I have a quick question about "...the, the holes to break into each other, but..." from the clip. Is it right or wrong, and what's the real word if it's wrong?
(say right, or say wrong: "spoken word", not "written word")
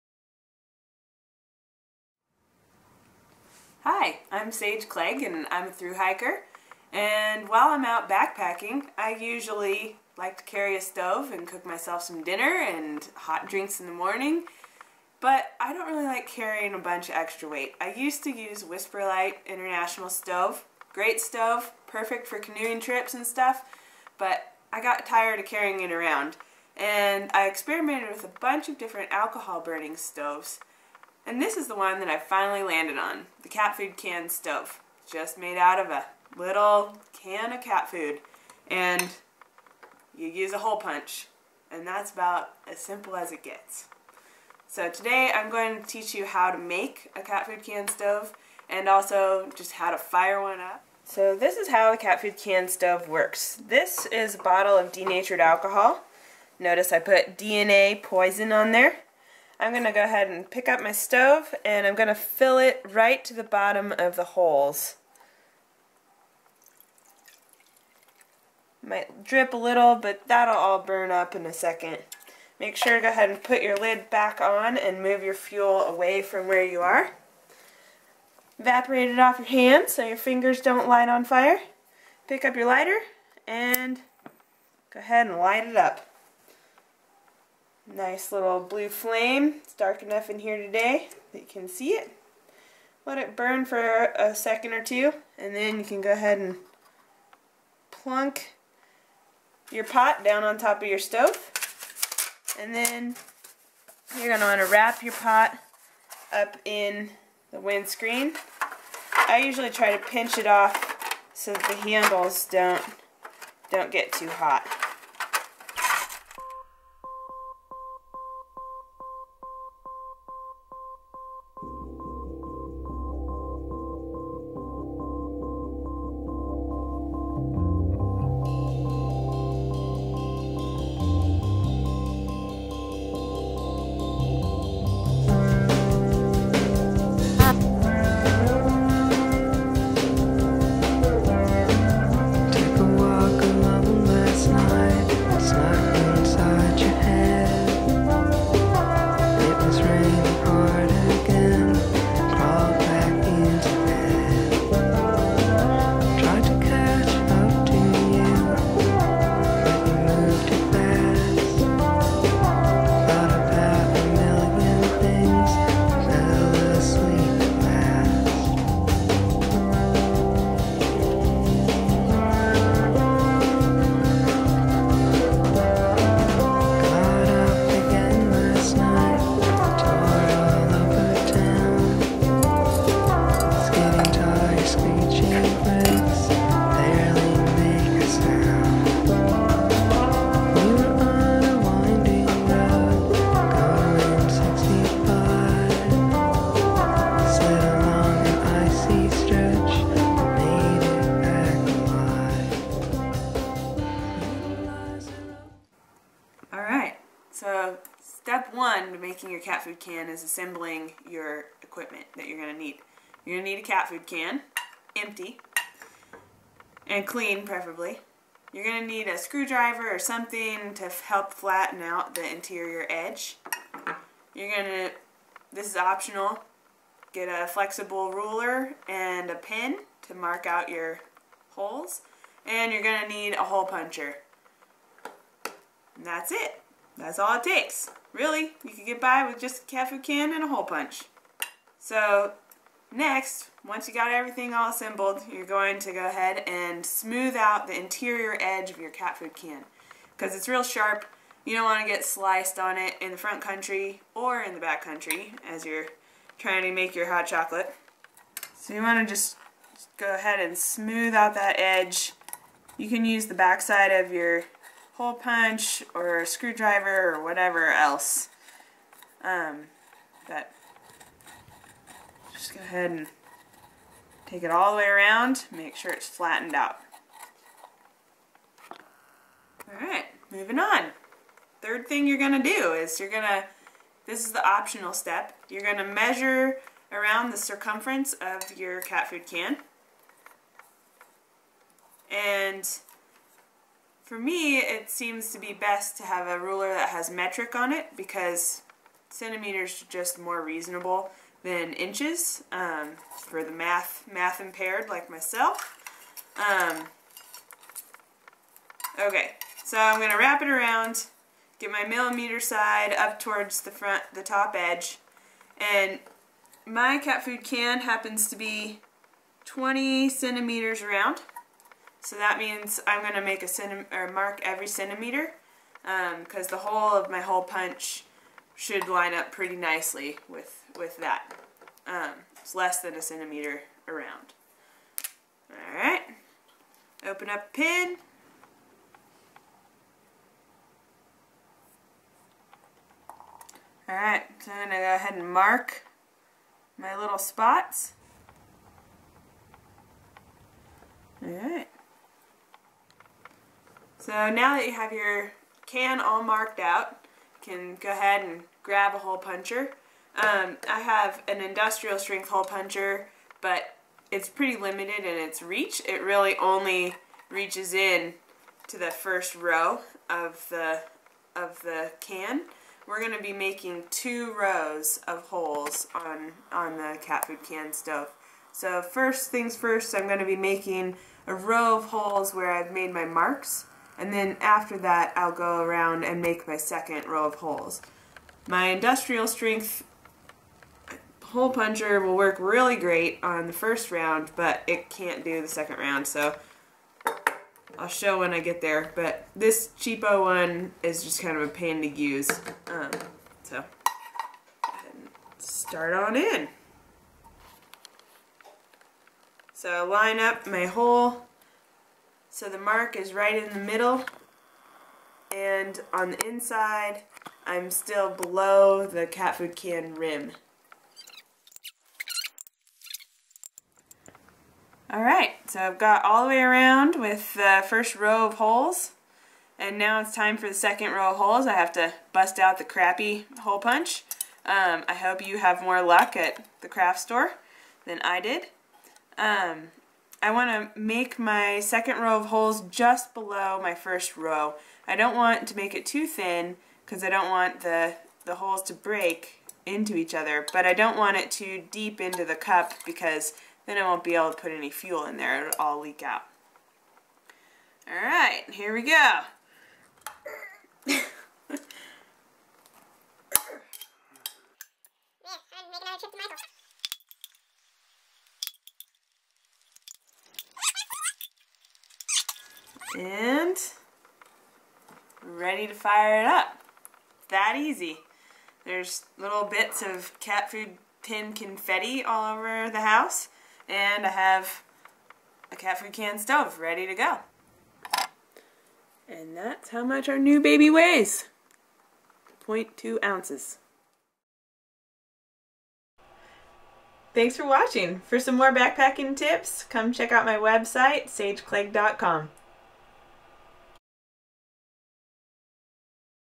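right.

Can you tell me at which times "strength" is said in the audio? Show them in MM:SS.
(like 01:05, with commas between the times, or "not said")
06:01, 06:29.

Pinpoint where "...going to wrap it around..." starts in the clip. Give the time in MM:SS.
05:09.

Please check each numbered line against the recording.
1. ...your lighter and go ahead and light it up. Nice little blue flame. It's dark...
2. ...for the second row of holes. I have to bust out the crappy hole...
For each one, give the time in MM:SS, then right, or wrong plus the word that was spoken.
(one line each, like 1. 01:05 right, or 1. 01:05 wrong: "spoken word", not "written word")
1. 01:22 right
2. 07:10 right.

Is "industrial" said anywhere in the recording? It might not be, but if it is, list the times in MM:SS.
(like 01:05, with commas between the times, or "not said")
06:01, 06:28.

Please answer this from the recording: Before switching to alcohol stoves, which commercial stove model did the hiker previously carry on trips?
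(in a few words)
WhisperLite International.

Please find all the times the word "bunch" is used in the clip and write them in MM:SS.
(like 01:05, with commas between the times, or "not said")
00:16, 00:28.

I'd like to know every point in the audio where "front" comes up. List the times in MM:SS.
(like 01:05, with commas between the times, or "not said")
04:13, 05:13.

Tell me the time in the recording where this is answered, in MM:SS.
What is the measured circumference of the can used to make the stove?
05:19.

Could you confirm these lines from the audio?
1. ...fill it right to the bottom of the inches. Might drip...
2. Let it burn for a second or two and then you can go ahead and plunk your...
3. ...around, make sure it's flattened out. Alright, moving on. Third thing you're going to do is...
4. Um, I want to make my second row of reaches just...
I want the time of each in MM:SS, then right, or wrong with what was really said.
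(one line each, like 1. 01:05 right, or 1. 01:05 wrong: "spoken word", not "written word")
1. 01:02 wrong: "holes", not "inches"
2. 01:33 right
3. 04:34 right
4. 07:19 wrong: "holes", not "reaches".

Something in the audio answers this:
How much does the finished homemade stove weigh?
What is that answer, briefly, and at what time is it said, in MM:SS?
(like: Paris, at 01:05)
0.2 ounces, at 08:12.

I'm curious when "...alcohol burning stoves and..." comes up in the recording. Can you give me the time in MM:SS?
00:29.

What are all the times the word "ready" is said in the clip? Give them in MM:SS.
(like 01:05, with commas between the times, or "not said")
07:55, 08:06.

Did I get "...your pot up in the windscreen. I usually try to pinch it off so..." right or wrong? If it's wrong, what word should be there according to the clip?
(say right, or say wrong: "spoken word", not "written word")
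right.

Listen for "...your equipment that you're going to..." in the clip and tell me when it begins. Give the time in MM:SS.
03:31.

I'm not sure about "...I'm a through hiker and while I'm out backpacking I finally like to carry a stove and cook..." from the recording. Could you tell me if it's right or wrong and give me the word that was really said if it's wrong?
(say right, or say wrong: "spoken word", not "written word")
wrong: "usually", not "finally".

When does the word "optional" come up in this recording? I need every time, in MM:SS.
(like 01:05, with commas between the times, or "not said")
03:45, 04:44.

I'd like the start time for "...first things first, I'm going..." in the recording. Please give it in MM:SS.
06:18.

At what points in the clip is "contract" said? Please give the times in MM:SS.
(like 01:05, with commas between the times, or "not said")
not said.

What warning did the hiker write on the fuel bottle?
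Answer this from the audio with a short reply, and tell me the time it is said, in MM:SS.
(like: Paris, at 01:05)
DNA poison, at 00:57.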